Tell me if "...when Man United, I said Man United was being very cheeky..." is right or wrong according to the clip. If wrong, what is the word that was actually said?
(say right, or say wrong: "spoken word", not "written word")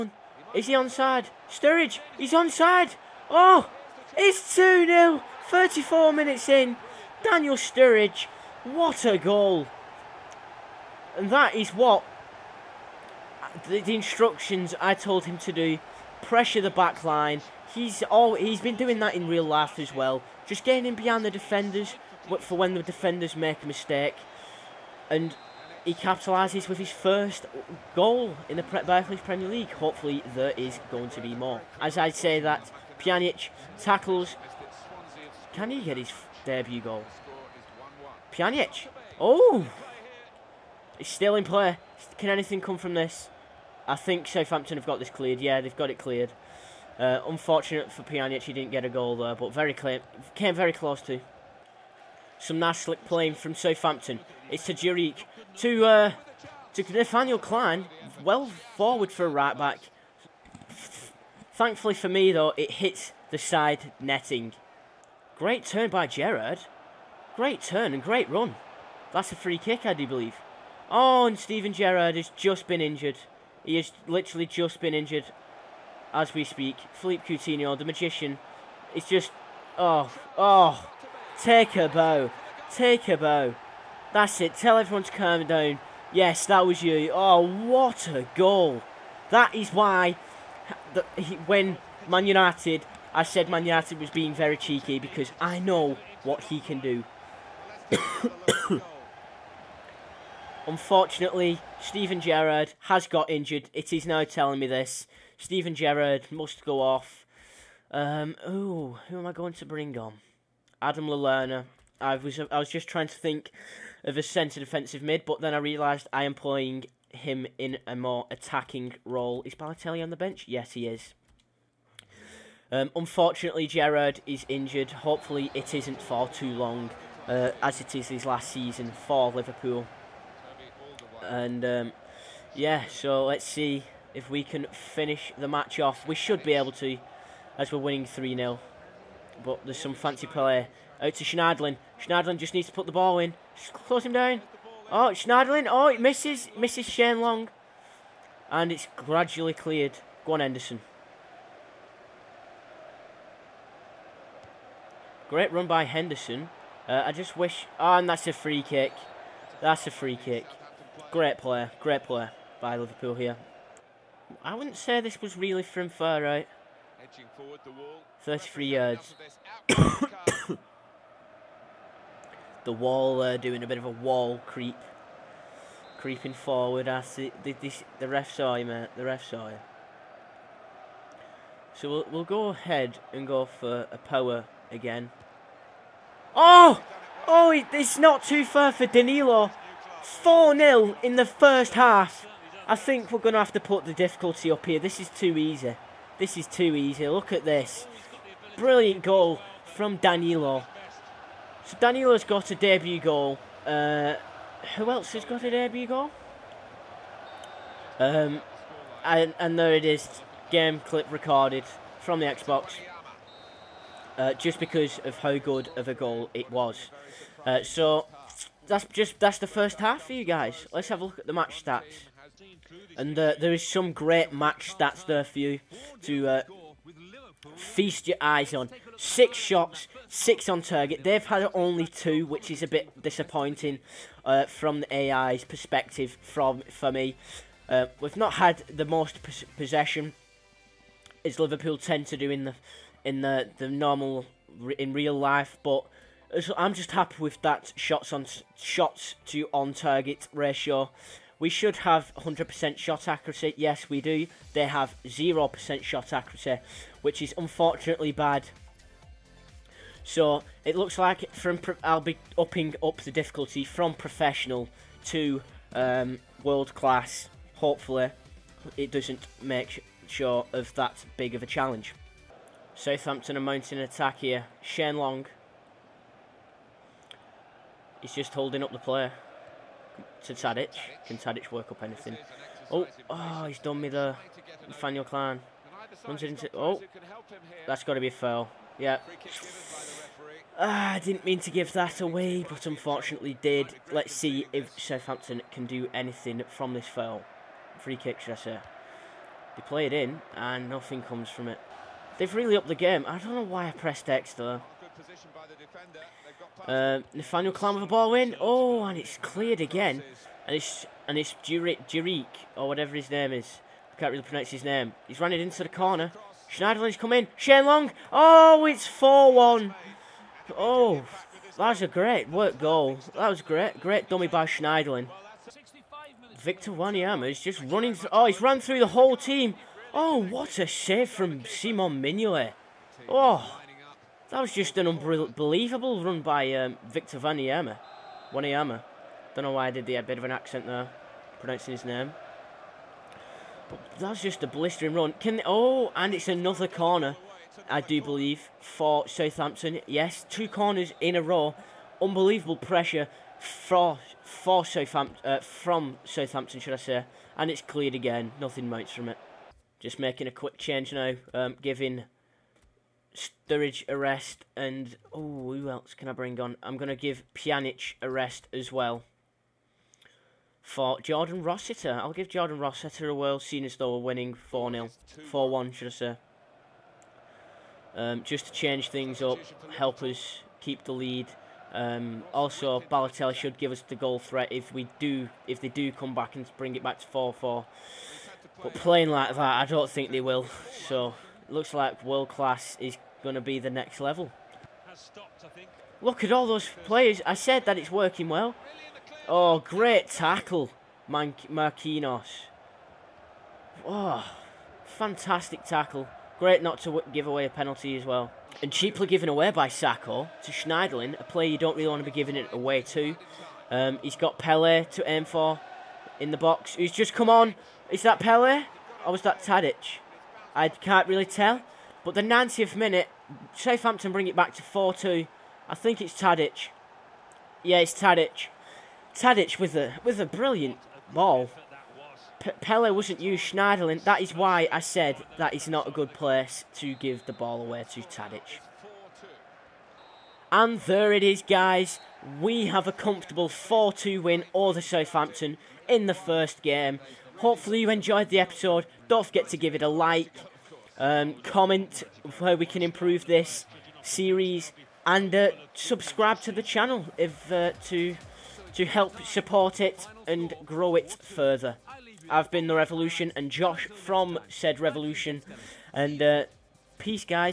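right.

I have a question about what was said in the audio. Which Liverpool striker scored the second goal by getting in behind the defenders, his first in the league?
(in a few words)
Daniel Sturridge.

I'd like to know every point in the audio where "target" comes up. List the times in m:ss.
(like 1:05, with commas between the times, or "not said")
3:50, 4:09.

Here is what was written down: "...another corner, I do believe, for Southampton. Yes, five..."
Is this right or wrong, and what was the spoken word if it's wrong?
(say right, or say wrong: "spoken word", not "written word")
wrong: "two", not "five".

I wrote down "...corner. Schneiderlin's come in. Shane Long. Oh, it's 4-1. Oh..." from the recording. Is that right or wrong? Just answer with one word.
right.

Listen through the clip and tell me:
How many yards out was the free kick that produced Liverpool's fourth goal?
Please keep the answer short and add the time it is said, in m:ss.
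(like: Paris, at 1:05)
33, at 2:48.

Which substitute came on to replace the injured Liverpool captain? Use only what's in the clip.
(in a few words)
Adam Lallana.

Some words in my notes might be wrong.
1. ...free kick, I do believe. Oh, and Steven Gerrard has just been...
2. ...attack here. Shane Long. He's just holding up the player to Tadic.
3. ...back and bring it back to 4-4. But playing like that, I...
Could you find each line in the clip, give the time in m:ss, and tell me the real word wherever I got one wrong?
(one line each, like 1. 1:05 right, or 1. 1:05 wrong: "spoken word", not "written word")
1. 1:09 right
2. 4:33 right
3. 6:26 right.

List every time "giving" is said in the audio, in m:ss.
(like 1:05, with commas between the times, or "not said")
6:01, 6:52.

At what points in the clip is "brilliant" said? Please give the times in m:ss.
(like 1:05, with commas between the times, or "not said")
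3:18, 7:10.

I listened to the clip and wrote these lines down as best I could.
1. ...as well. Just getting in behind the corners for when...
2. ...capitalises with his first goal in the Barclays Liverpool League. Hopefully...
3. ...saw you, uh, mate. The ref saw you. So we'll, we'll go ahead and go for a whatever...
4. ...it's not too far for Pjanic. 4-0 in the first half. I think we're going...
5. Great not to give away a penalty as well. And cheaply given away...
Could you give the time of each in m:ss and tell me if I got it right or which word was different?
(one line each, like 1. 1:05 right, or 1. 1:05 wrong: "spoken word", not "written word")
1. 0:19 wrong: "defenders", not "corners"
2. 0:25 wrong: "Premier", not "Liverpool"
3. 2:58 wrong: "power", not "whatever"
4. 3:07 wrong: "Danilo", not "Pjanic"
5. 6:46 right.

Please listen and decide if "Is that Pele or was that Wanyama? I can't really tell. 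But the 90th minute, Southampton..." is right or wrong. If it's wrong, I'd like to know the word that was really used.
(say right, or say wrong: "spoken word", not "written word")
wrong: "Tadic", not "Wanyama".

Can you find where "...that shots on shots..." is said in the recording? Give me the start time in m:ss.
4:07.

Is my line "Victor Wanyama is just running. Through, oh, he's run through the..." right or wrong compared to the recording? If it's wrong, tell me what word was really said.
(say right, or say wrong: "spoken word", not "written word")
right.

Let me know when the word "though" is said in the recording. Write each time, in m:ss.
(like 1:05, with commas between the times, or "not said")
1:02, 5:04, 6:13.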